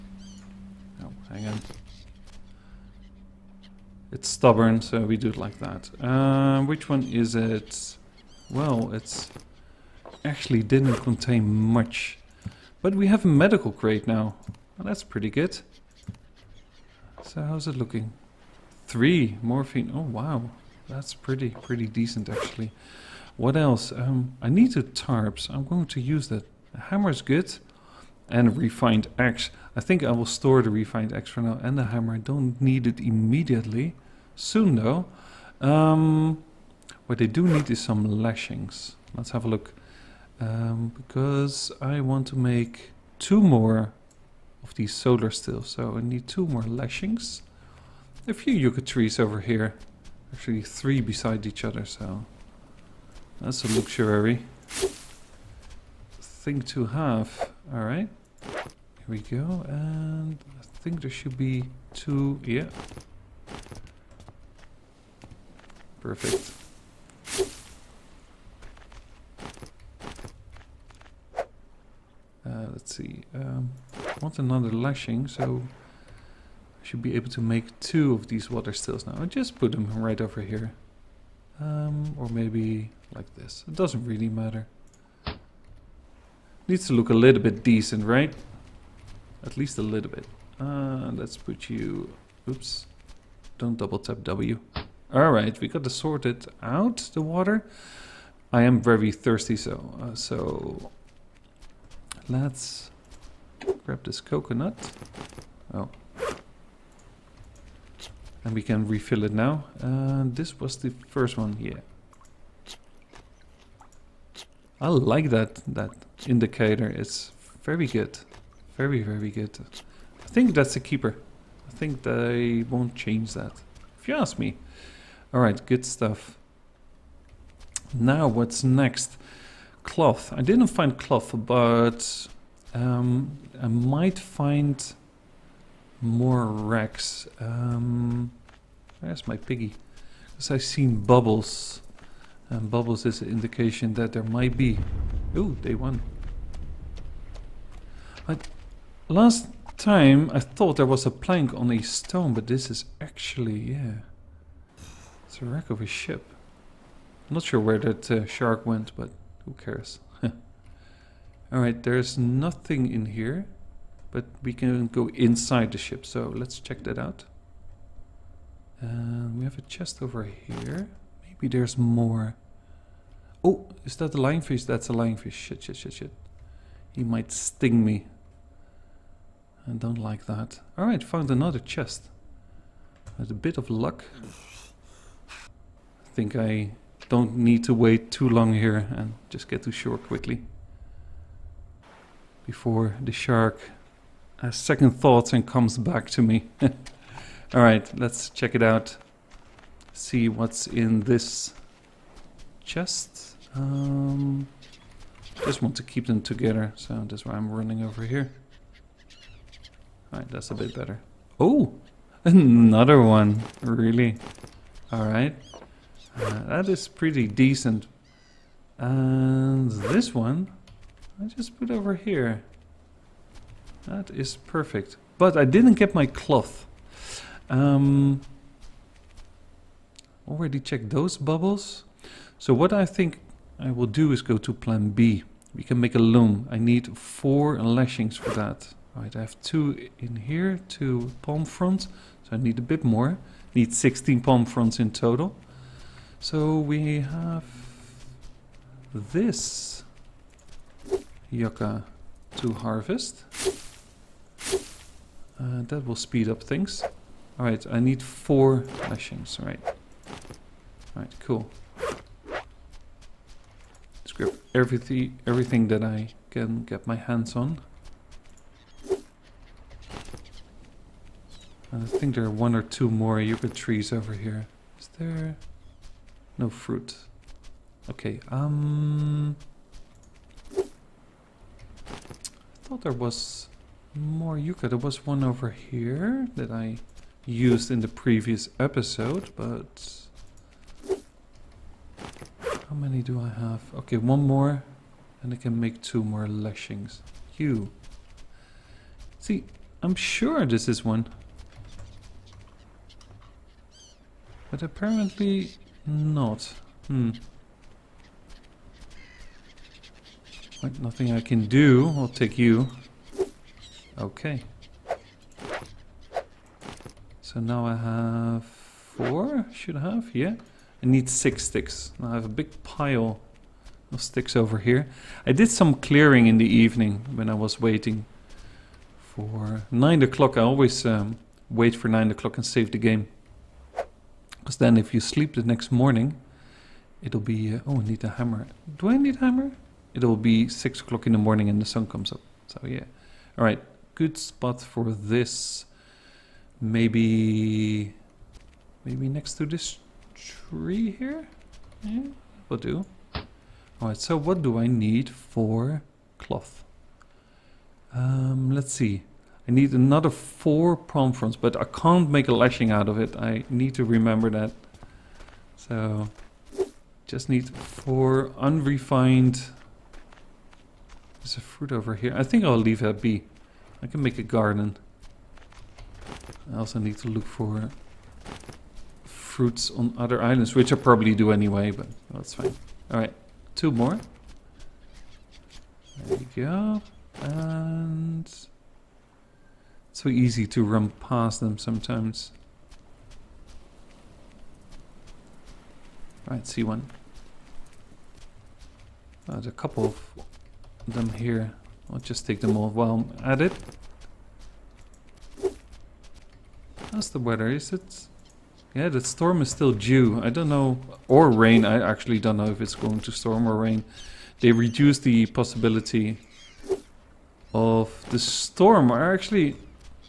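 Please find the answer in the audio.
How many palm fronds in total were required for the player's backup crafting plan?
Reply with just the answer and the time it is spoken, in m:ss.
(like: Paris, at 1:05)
16, at 4:03.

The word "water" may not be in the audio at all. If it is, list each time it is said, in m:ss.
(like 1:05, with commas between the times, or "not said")
1:18, 1:37.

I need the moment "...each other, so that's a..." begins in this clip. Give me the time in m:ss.
0:51.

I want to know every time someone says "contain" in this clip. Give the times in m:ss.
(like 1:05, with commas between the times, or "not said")
0:10.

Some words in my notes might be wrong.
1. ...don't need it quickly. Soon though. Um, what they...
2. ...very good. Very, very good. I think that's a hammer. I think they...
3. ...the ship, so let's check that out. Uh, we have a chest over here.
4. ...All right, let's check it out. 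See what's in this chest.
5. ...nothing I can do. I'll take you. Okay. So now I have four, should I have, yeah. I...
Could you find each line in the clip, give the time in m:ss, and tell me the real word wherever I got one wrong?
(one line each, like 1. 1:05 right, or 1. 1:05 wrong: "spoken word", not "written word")
1. 0:32 wrong: "immediately", not "quickly"
2. 1:57 wrong: "keeper", not "hammer"
3. 2:45 right
4. 3:16 right
5. 5:10 right.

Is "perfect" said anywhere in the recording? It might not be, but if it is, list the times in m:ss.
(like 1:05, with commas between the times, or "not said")
1:06, 3:44.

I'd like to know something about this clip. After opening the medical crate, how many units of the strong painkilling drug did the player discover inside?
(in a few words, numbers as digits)
3.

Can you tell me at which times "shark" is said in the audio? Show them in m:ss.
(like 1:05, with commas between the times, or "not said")
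2:38, 3:13.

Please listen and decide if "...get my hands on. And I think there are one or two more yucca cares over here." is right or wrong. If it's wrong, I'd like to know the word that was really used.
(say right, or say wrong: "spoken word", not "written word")
wrong: "trees", not "cares".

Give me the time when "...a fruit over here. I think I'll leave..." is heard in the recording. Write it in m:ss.
6:11.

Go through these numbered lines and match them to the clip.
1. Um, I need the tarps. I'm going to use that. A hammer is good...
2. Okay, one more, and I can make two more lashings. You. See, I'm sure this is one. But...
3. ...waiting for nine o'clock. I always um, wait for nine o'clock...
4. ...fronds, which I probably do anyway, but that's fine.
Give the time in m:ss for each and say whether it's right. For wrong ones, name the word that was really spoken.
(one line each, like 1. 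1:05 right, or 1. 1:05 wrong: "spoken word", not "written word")
1. 0:23 right
2. 4:53 right
3. 5:27 right
4. 6:20 wrong: "islands", not "fronds".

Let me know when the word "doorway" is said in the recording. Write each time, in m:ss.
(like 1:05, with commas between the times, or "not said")
not said.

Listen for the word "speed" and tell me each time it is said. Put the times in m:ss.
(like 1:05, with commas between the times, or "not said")
4:15.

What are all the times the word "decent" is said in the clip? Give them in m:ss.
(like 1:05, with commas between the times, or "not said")
0:21, 1:27, 3:37.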